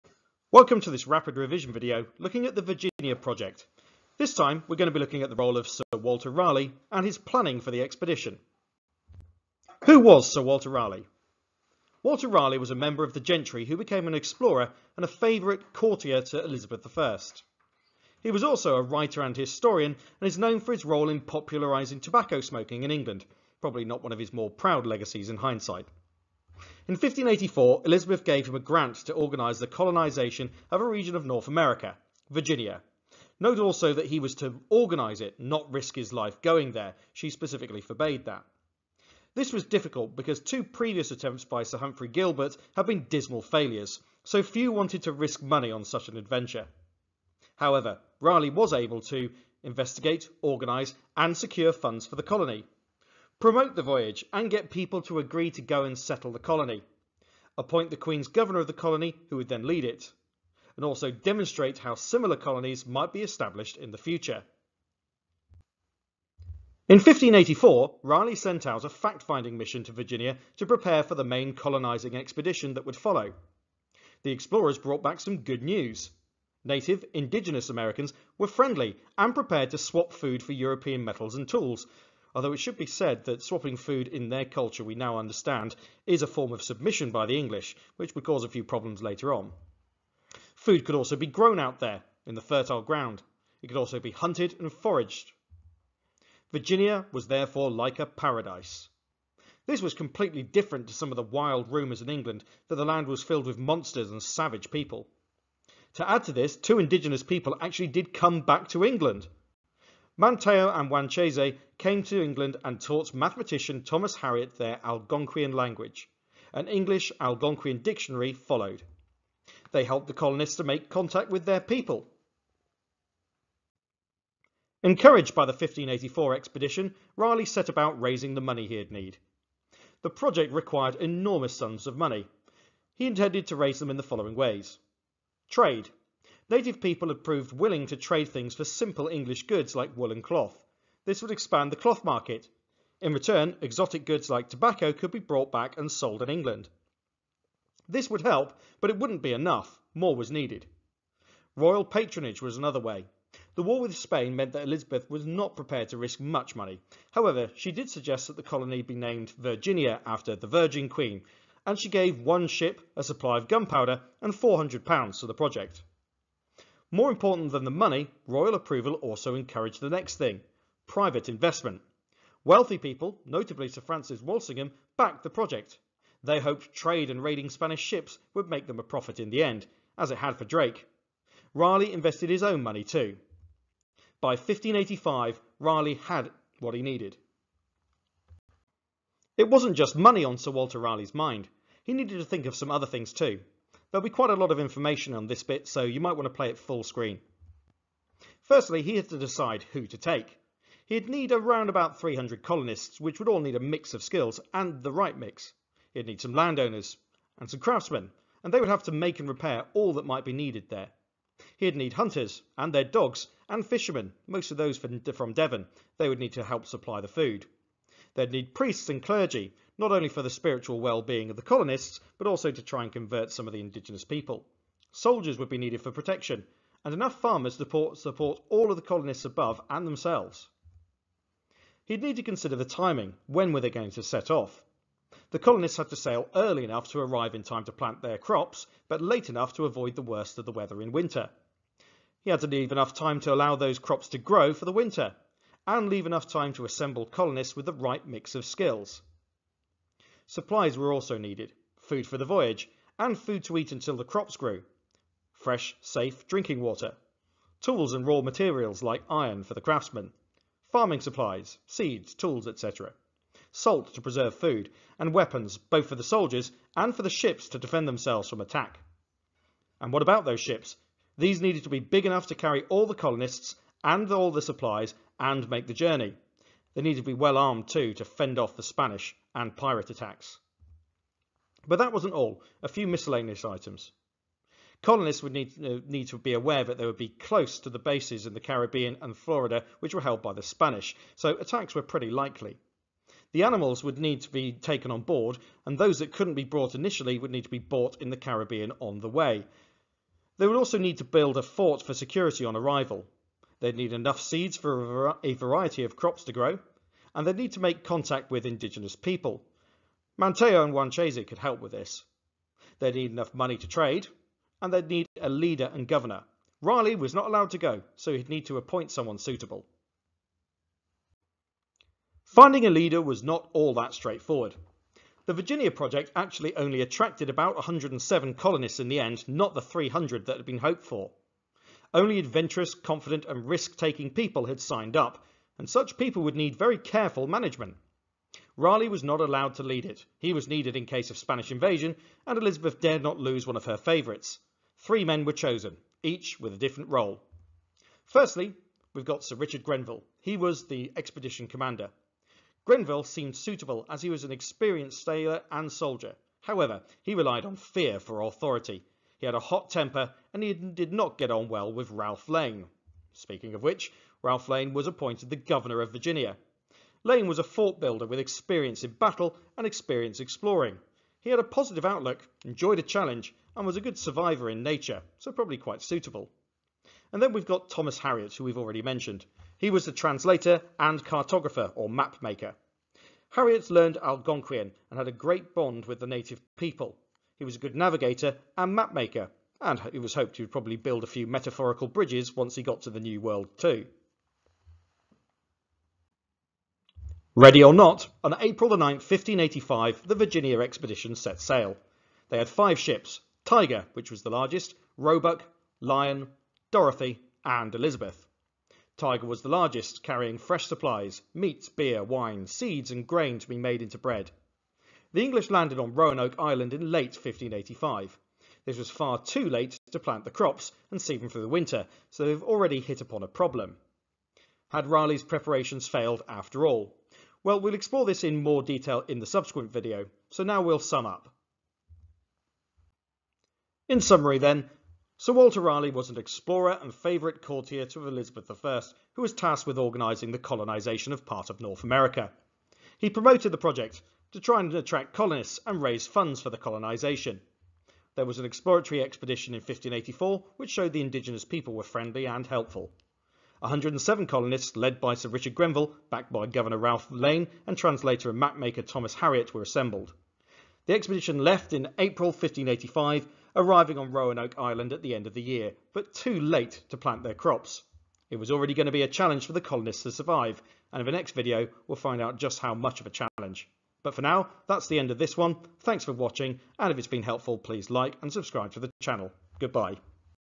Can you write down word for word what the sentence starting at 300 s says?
They would also need to build a fort for security on arrival.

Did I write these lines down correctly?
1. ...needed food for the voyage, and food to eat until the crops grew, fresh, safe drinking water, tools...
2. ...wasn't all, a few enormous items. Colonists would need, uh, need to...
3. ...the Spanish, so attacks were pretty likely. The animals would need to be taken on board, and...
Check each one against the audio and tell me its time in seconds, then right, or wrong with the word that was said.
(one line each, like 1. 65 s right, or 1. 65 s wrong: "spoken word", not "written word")
1. 251 s right
2. 281 s wrong: "miscellaneous", not "enormous"
3. 290 s right.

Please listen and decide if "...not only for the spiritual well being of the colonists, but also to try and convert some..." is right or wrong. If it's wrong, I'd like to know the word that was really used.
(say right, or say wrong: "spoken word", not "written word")
right.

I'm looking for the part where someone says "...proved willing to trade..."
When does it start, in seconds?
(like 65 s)
137 s.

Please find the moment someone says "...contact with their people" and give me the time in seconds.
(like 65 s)
120 s.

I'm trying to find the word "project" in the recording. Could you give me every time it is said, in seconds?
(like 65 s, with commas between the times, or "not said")
3 s, 130 s, 165 s, 175 s, 325 s, 443 s.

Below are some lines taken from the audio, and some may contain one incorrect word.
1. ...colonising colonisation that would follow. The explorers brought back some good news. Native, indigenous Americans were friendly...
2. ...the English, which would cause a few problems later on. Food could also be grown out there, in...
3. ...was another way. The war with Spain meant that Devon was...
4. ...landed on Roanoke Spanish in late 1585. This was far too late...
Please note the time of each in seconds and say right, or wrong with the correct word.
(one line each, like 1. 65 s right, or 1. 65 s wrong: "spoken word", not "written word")
1. 71 s wrong: "expedition", not "colonisation"
2. 87 s right
3. 152 s wrong: "Elizabeth", not "Devon"
4. 415 s wrong: "Island", not "Spanish".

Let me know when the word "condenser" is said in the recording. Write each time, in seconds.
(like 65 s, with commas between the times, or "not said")
not said.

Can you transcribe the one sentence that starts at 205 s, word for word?
He'd need some landowners and some craftsmen, and they would have to make and repair all that might be needed there.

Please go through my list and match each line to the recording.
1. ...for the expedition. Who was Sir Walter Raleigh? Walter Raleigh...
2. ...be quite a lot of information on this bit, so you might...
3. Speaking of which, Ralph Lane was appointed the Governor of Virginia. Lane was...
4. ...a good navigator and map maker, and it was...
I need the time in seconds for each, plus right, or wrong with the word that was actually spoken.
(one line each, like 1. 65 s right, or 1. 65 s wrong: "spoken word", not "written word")
1. 7 s right
2. 194 s right
3. 363 s right
4. 387 s right.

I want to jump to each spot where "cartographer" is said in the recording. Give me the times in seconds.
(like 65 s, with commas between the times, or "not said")
381 s.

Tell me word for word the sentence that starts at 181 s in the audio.
Raleigh invested his own money too.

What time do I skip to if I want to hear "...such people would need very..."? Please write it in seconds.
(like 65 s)
335 s.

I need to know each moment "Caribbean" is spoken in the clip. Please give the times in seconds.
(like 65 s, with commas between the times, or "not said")
288 s, 298 s.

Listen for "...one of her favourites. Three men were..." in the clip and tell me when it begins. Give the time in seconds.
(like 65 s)
343 s.